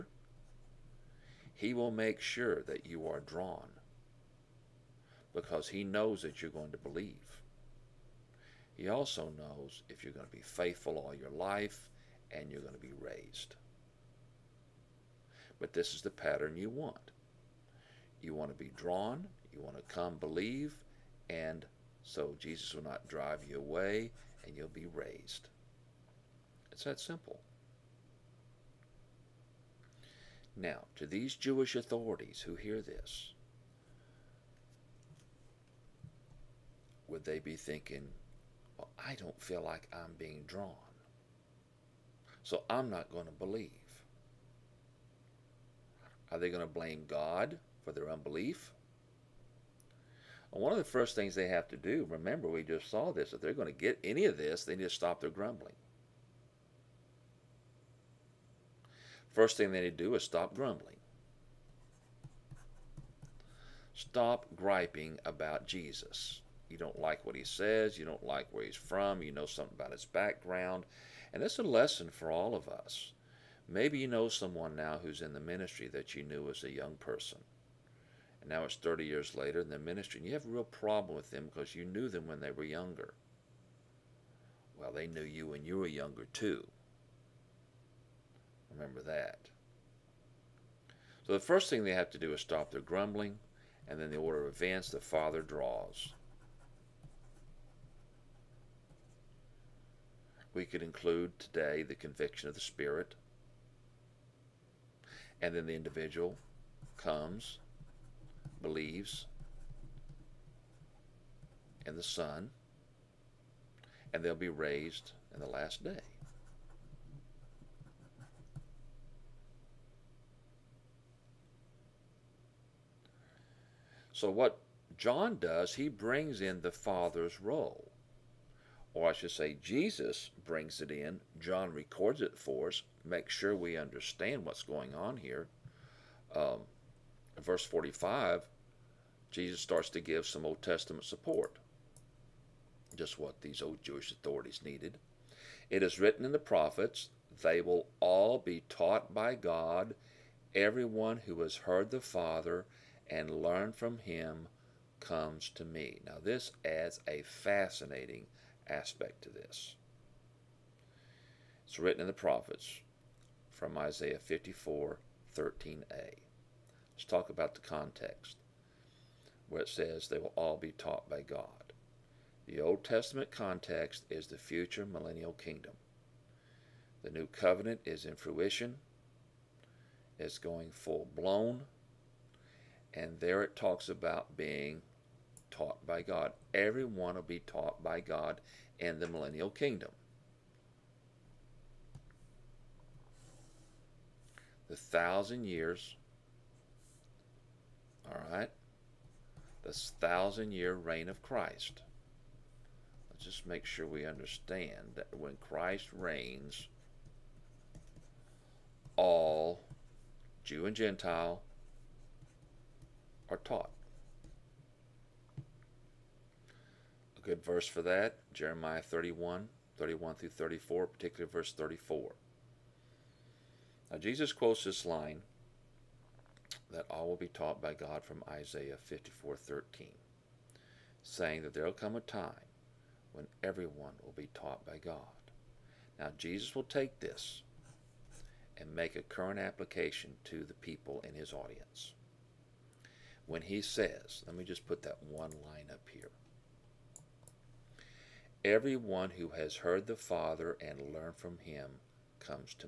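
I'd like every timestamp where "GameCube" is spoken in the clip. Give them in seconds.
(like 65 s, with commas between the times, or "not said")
not said.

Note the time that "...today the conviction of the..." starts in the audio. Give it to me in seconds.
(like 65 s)
101 s.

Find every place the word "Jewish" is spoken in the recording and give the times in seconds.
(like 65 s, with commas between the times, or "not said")
31 s, 143 s.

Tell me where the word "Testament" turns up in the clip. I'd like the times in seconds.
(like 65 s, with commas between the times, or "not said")
140 s, 172 s.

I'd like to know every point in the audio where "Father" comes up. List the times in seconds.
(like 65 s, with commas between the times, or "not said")
94 s, 126 s, 152 s, 249 s.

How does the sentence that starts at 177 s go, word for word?
The new covenant is in fruition, it's going full blown, and there it talks about being taught by God.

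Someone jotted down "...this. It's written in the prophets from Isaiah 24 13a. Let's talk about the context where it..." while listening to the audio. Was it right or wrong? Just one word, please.
wrong.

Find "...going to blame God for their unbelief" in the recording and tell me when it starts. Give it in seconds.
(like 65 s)
46 s.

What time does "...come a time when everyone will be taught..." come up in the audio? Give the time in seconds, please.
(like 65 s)
231 s.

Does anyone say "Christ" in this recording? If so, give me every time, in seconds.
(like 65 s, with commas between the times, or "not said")
201 s, 205 s.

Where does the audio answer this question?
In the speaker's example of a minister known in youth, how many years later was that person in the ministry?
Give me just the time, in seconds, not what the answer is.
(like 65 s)
78 s.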